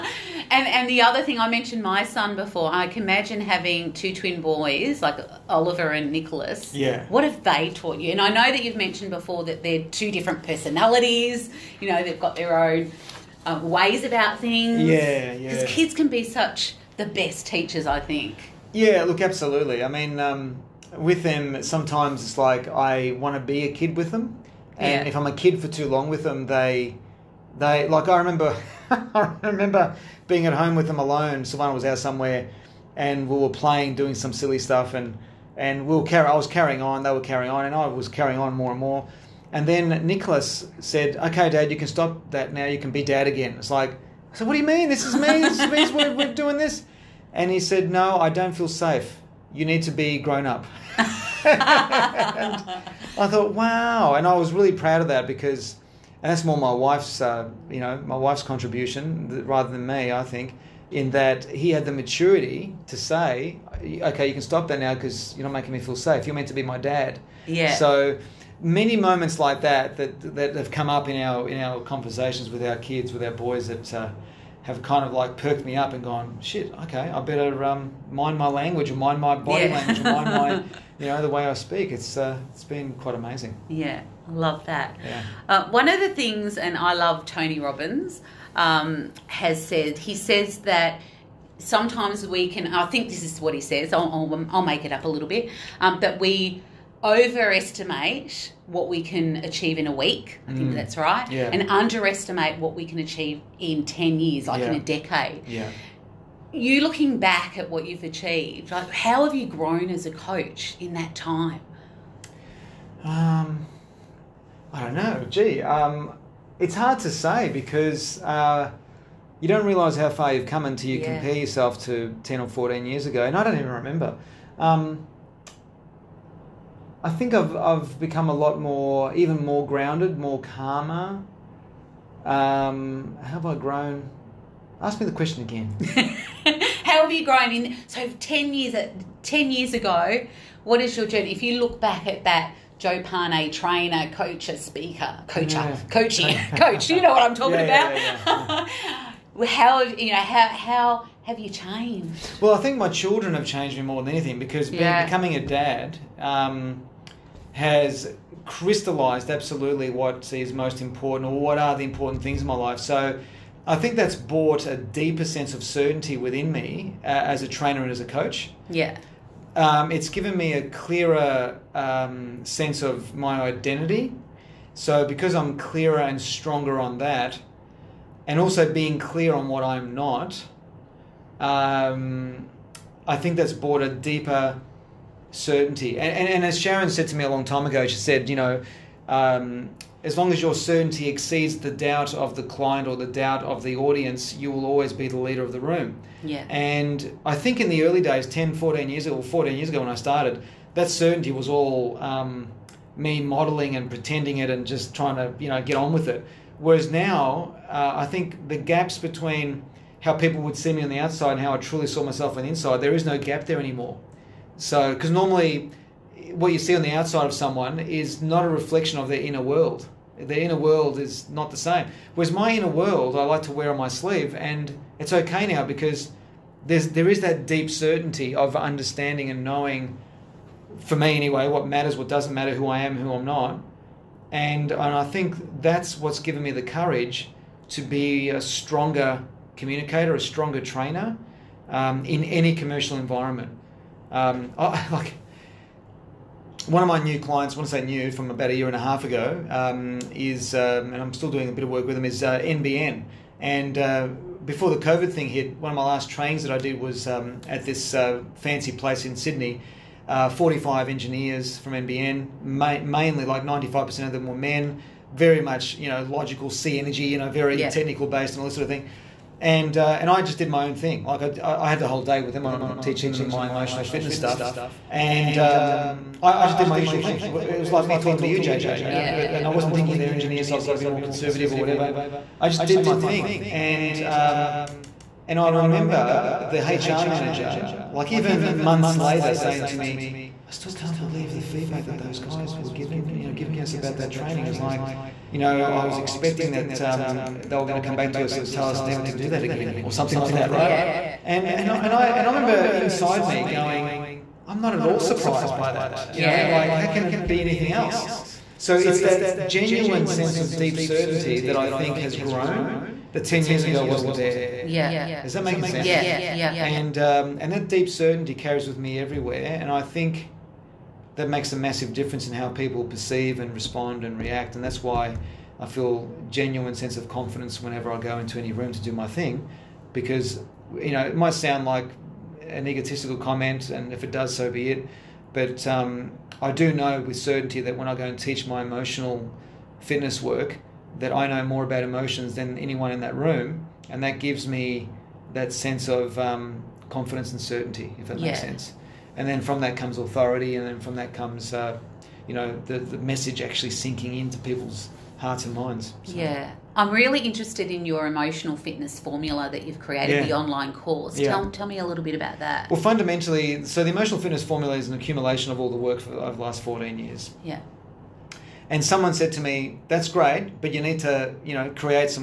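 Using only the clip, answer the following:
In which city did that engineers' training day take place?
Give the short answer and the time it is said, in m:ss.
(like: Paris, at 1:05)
Sydney, at 4:19.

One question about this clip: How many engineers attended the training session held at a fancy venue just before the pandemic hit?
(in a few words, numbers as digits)
45.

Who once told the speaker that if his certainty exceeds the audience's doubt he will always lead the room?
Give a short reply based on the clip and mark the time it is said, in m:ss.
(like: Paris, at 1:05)
Sharon, at 3:06.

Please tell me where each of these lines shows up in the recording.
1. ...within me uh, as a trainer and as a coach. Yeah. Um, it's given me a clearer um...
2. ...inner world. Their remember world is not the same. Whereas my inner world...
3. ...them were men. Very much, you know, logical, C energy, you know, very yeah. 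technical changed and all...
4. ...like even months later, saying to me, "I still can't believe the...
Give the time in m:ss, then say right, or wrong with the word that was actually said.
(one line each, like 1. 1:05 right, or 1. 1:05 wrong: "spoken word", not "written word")
1. 2:46 right
2. 3:39 wrong: "inner", not "remember"
3. 4:24 wrong: "based", not "changed"
4. 4:47 right.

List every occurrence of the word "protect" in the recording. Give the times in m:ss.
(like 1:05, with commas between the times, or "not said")
not said.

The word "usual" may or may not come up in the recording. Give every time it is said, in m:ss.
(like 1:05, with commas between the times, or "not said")
4:36.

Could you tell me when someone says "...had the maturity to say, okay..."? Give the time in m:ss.
1:01.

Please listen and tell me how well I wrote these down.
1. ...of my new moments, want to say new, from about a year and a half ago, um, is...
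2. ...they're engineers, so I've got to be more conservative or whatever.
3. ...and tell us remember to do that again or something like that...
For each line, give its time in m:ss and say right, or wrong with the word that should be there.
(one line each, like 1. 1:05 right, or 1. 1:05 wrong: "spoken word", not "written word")
1. 4:06 wrong: "clients", not "moments"
2. 4:39 right
3. 4:58 wrong: "never", not "remember".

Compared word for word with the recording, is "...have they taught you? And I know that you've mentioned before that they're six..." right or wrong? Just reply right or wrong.
wrong.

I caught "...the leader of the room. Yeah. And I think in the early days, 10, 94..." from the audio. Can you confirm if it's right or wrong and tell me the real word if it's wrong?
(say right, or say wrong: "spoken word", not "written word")
wrong: "14", not "94".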